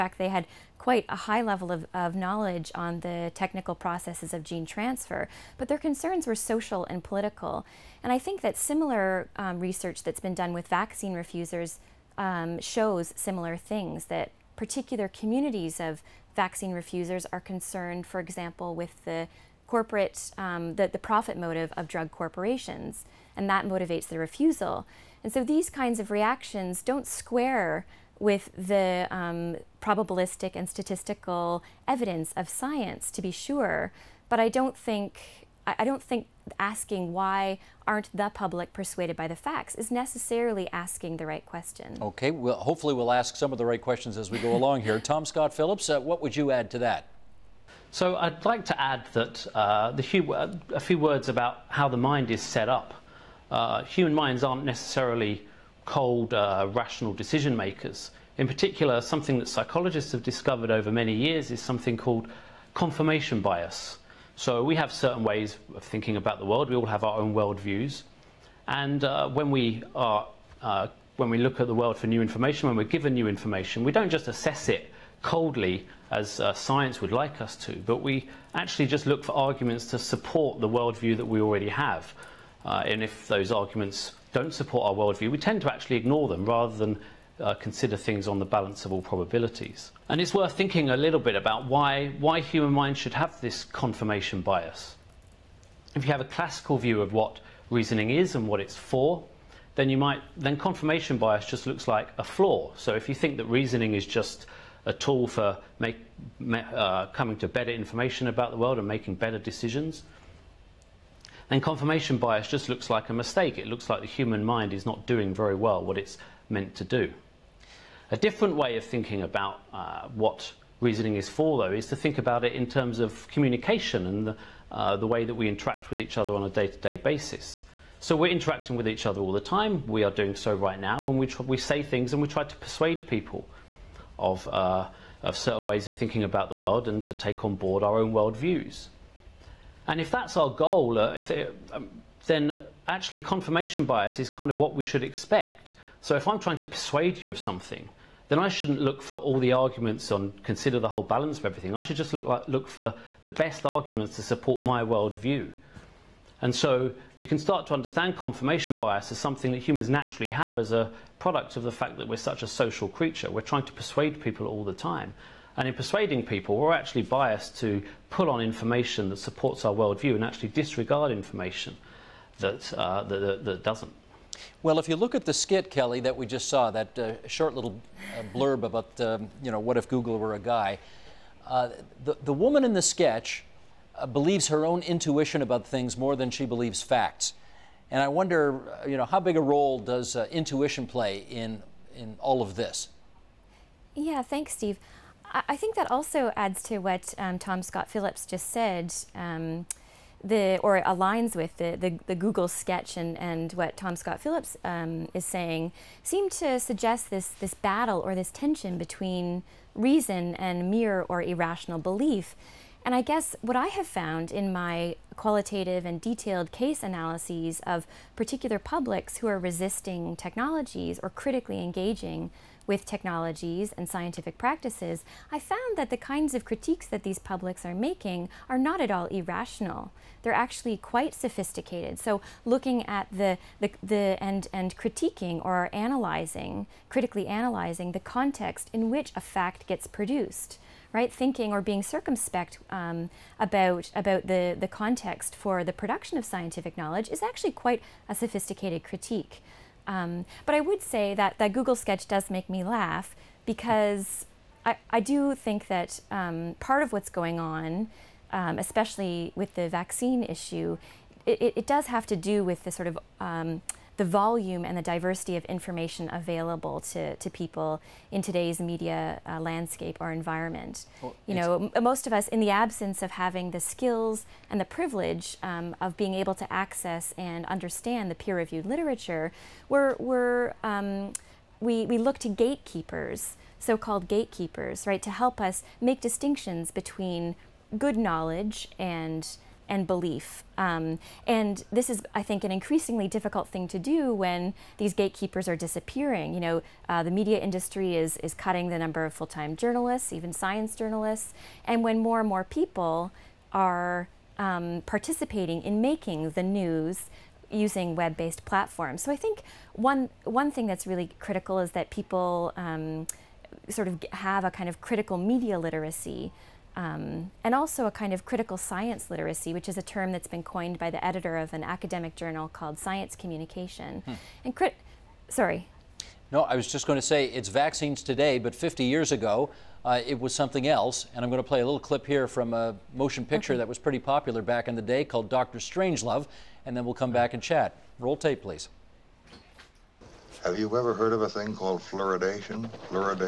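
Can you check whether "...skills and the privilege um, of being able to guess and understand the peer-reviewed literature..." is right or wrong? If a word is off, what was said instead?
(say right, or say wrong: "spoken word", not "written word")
wrong: "access", not "guess".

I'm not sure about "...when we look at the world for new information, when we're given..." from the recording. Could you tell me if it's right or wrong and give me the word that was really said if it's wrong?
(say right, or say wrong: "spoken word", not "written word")
right.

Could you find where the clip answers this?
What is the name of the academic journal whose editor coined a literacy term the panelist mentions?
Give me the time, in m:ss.
5:22.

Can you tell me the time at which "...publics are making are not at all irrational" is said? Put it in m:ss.
3:47.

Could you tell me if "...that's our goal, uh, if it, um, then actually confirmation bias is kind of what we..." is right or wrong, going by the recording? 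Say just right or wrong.
right.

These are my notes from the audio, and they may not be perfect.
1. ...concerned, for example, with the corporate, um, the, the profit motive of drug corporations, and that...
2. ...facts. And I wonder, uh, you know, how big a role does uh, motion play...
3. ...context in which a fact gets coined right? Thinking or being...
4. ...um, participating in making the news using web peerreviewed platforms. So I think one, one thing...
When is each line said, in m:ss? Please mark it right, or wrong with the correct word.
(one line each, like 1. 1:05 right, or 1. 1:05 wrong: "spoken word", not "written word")
1. 0:17 right
2. 3:06 wrong: "intuition", not "motion"
3. 3:57 wrong: "produced", not "coined"
4. 5:04 wrong: "based", not "peerreviewed".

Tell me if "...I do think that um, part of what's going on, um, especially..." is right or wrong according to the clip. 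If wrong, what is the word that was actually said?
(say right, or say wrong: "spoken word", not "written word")
right.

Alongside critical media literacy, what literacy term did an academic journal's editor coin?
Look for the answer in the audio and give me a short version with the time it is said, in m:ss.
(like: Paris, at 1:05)
critical science literacy, at 5:18.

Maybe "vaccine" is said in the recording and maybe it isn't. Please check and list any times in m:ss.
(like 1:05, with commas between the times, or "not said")
0:10, 0:16, 4:19, 5:27.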